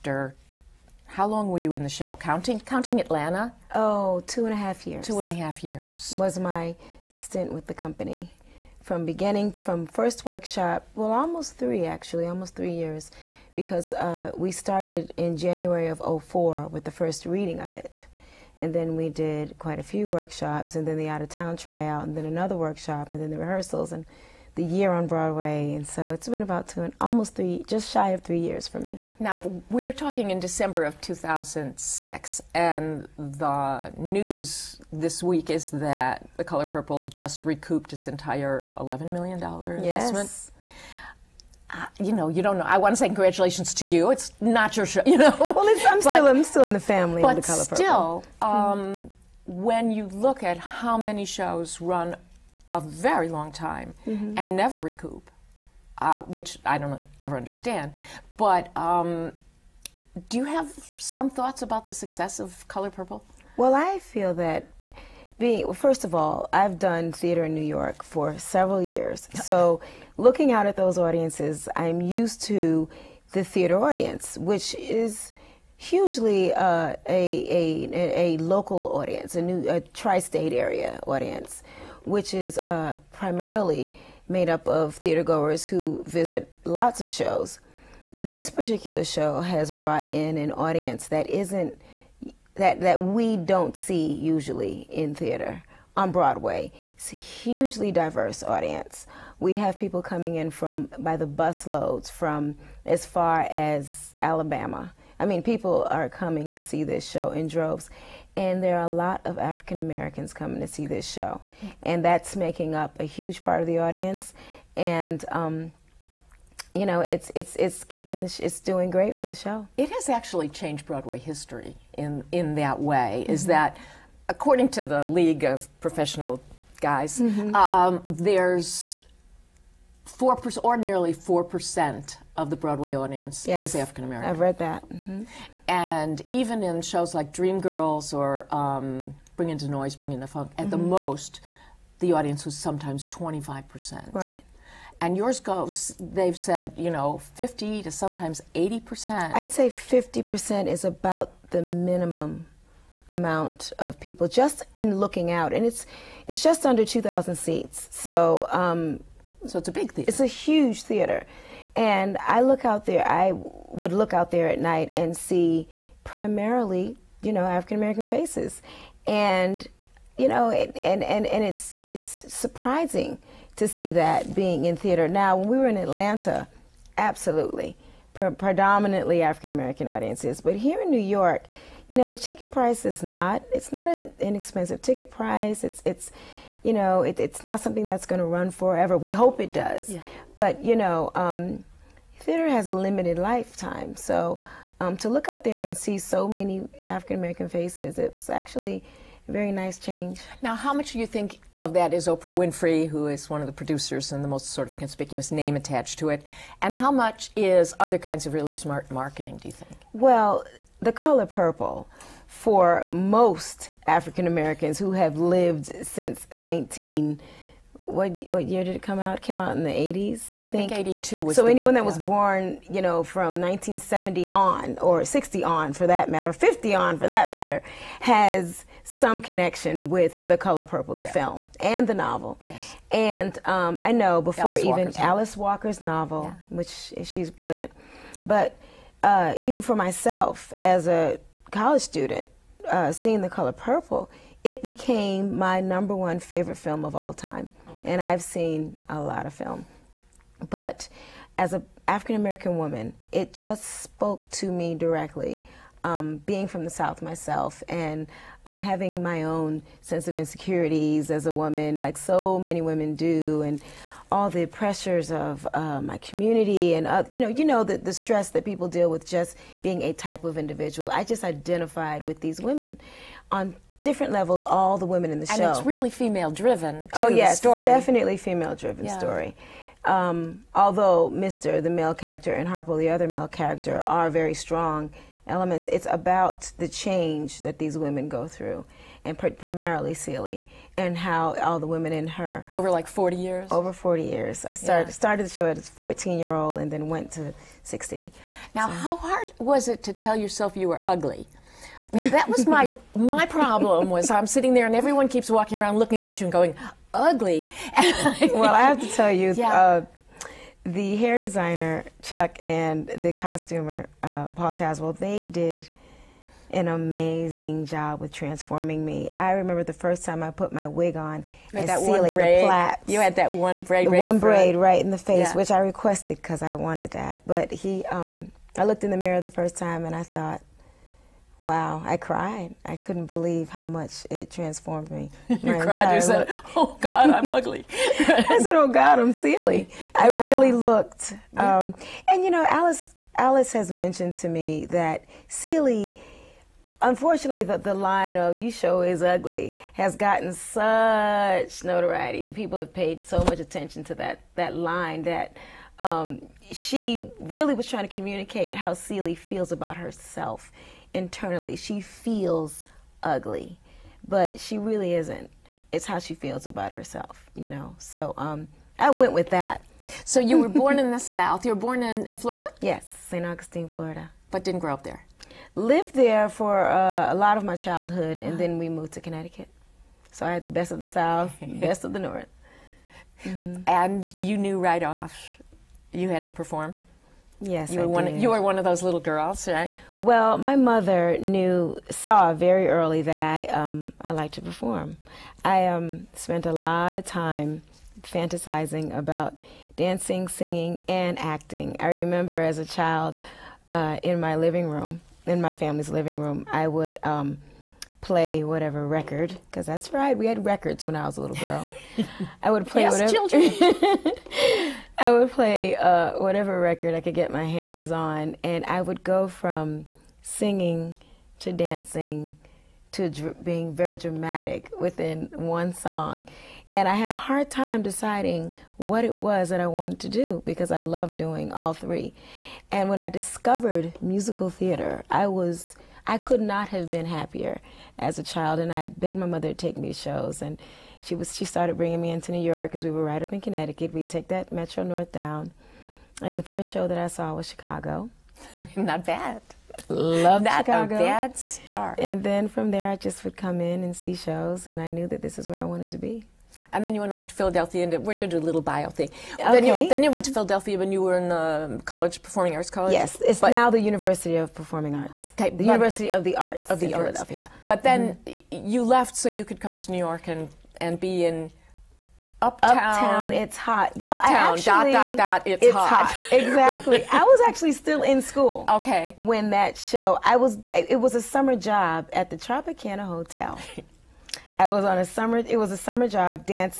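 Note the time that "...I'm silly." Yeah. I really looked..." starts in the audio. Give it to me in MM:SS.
05:38.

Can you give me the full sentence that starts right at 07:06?
And I had a hard time deciding what it was that I wanted to do because I loved doing all three.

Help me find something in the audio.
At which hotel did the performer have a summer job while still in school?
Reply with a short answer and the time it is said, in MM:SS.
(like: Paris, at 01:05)
Tropicana Hotel, at 08:02.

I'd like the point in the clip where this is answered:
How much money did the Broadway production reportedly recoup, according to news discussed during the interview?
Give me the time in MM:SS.
00:38.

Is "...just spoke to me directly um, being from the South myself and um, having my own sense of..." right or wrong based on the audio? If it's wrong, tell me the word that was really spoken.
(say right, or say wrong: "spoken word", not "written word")
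right.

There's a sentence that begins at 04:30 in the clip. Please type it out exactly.
I just identified with these women on different levels.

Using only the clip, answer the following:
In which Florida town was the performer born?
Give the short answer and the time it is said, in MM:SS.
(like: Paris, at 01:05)
St. Augustine, at 06:13.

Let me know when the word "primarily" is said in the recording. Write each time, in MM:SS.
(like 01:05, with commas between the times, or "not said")
01:23, 02:46, 04:49.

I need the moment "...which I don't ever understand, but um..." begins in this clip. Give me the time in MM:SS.
00:56.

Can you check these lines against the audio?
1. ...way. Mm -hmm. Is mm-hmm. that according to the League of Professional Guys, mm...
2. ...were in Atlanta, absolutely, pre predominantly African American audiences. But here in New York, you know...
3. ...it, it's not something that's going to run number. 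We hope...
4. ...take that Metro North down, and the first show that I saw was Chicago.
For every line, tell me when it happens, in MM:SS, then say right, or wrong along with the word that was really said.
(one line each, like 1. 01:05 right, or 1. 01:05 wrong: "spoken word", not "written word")
1. 02:02 right
2. 02:55 right
3. 03:07 wrong: "forever", not "number"
4. 07:24 right.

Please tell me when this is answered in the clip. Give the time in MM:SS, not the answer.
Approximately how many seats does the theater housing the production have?
02:36.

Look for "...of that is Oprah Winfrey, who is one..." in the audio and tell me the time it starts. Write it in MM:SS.
03:21.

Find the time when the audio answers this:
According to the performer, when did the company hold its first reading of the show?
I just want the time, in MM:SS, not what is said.
00:15.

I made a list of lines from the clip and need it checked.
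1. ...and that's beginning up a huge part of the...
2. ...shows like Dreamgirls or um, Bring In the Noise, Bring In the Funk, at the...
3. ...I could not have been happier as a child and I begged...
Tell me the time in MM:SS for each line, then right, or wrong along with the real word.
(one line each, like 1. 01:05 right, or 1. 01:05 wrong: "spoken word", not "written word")
1. 01:51 wrong: "making", not "beginning"
2. 02:16 right
3. 07:16 right.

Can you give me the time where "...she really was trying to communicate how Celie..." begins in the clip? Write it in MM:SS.
05:56.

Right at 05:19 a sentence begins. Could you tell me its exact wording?
I remember the first time I put my wig on and that the plaits.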